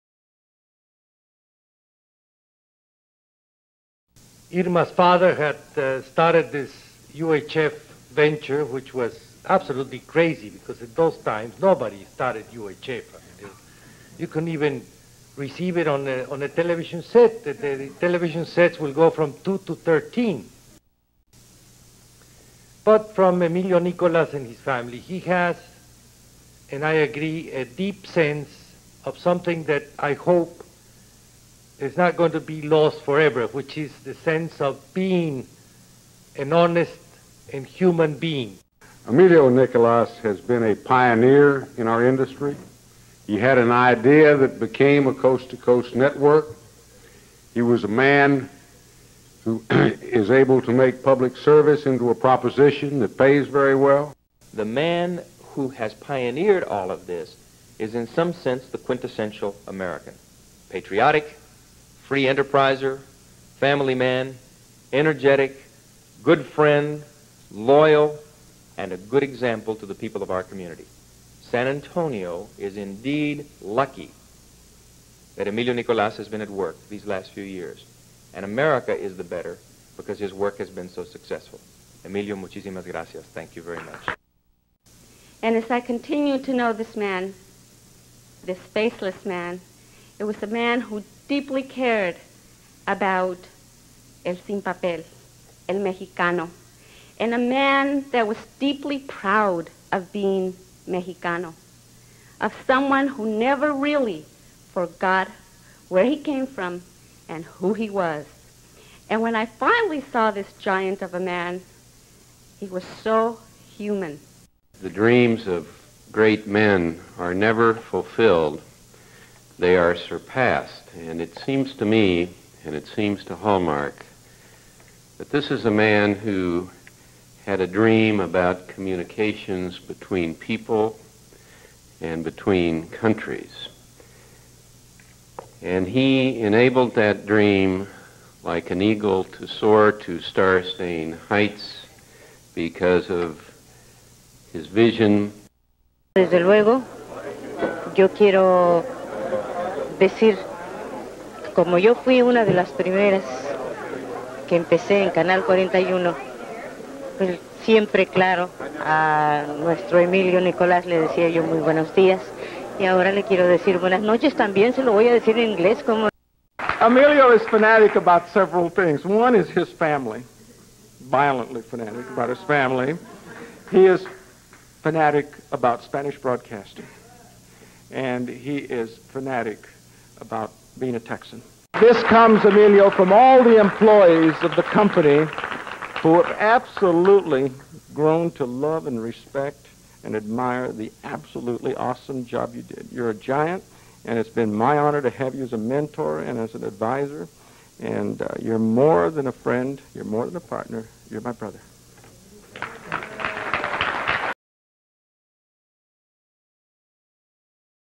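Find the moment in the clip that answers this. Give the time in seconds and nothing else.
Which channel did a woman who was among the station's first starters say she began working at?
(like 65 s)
155 s.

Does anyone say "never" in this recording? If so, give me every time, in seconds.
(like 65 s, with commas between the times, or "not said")
103 s, 117 s.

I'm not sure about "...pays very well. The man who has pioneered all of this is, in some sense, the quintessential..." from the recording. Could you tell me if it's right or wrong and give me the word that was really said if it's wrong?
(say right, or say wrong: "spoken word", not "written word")
right.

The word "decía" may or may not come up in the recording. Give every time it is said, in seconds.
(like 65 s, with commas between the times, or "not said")
161 s.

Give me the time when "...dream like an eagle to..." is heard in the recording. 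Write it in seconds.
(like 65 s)
137 s.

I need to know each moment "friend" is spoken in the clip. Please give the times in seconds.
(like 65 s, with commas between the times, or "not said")
66 s, 199 s.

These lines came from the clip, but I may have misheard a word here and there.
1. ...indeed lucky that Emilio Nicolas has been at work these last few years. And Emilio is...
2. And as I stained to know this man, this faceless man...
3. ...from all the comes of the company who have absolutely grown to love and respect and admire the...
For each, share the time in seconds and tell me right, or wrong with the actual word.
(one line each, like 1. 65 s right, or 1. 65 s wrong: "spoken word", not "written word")
1. 72 s wrong: "America", not "Emilio"
2. 85 s wrong: "continued", not "stained"
3. 182 s wrong: "employees", not "comes".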